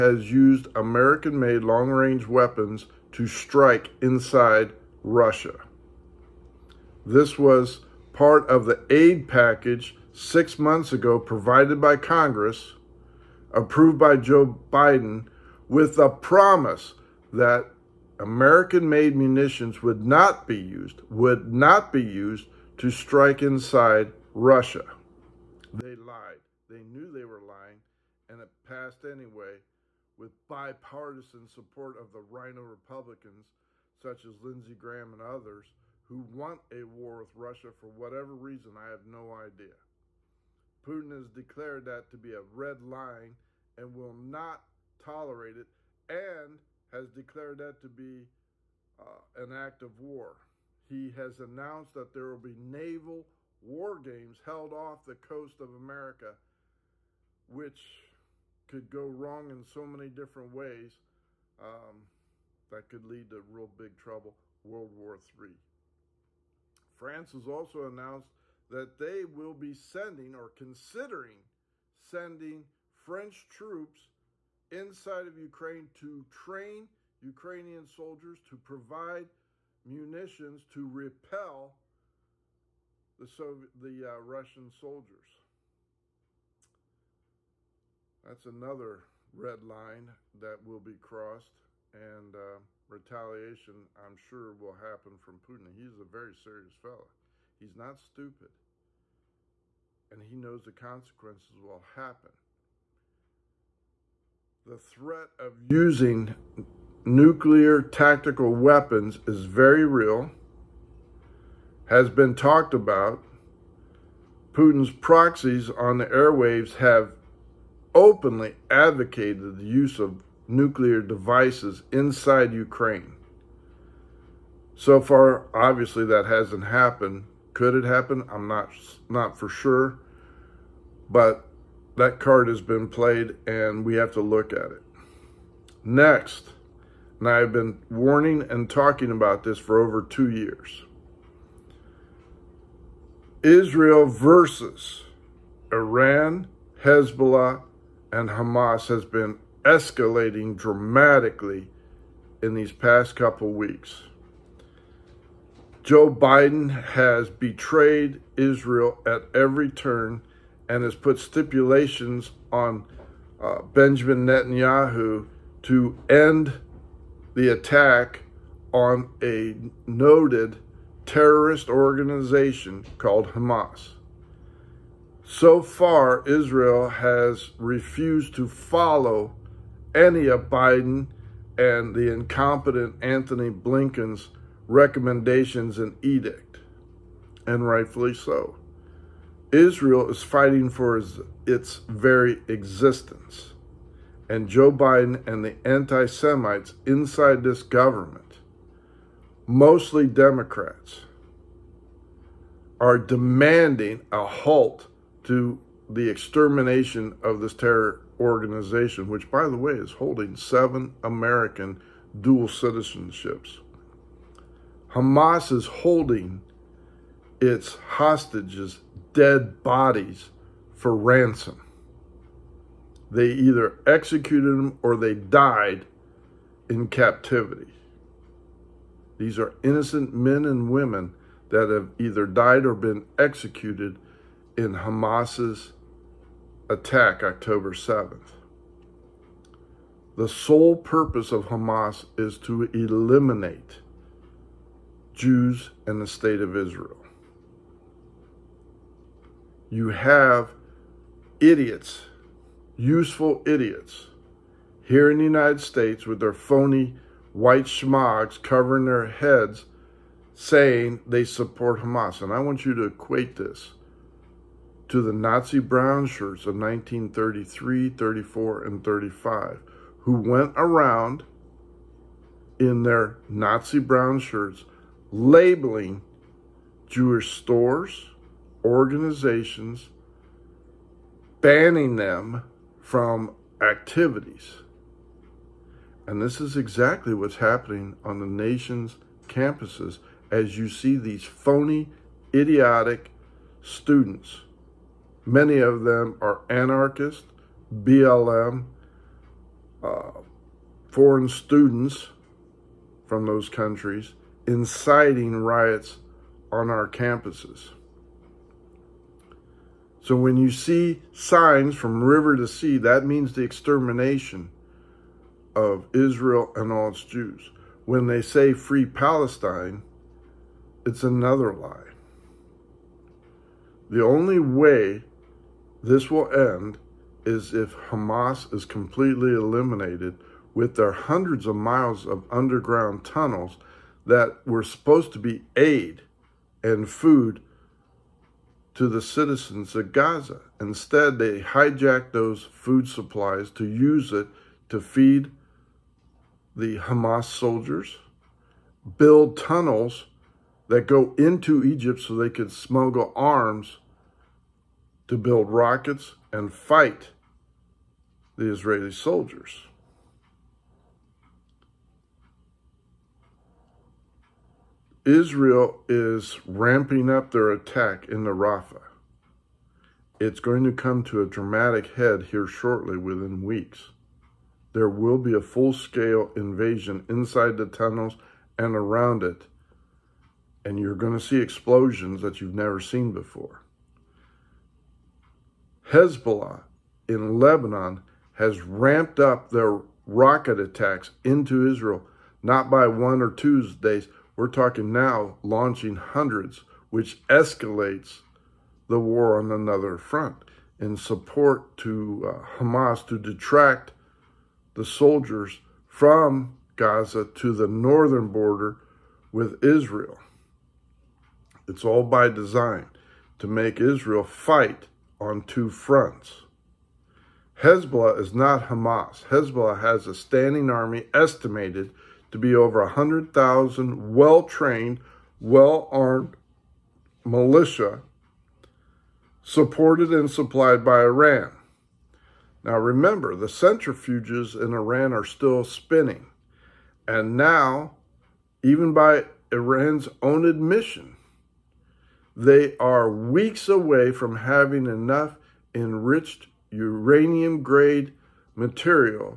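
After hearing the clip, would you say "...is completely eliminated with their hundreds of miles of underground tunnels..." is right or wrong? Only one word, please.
right.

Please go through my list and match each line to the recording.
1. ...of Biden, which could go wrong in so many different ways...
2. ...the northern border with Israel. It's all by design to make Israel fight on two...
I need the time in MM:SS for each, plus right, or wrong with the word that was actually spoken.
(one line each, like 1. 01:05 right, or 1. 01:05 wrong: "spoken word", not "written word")
1. 00:55 wrong: "America", not "Biden"
2. 06:47 right.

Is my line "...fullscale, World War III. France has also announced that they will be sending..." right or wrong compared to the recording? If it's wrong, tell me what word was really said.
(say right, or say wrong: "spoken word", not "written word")
wrong: "trouble", not "fullscale".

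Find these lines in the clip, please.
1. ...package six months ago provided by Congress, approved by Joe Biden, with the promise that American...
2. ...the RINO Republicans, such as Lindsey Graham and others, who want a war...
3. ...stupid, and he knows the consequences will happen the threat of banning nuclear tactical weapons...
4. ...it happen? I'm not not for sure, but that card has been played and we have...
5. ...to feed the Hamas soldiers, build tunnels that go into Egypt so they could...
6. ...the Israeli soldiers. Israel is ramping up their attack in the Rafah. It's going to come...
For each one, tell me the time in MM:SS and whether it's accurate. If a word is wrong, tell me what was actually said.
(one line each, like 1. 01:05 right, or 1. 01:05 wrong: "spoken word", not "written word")
1. 00:09 right
2. 00:32 right
3. 01:37 wrong: "using", not "banning"
4. 02:07 right
5. 05:44 right
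6. 05:58 right.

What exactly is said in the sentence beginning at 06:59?
Hezbollah has a standing army estimated to be over 100,000 well trained, well armed militia supported and supplied by Iran.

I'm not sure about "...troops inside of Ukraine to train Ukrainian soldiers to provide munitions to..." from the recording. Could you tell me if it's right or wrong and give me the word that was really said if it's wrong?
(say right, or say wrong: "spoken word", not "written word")
right.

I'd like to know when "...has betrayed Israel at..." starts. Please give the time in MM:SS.
02:36.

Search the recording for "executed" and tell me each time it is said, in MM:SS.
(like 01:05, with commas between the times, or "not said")
03:43, 03:53.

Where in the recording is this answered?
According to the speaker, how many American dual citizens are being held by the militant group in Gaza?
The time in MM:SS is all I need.
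03:30.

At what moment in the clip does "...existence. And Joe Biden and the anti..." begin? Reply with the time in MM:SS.
03:12.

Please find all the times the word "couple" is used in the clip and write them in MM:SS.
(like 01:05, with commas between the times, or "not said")
02:33.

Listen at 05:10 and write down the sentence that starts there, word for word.
So when you see signs from river to sea, that means the extermination of Israel and all its Jews.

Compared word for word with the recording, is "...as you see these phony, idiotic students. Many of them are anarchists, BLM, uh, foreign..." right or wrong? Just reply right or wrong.
right.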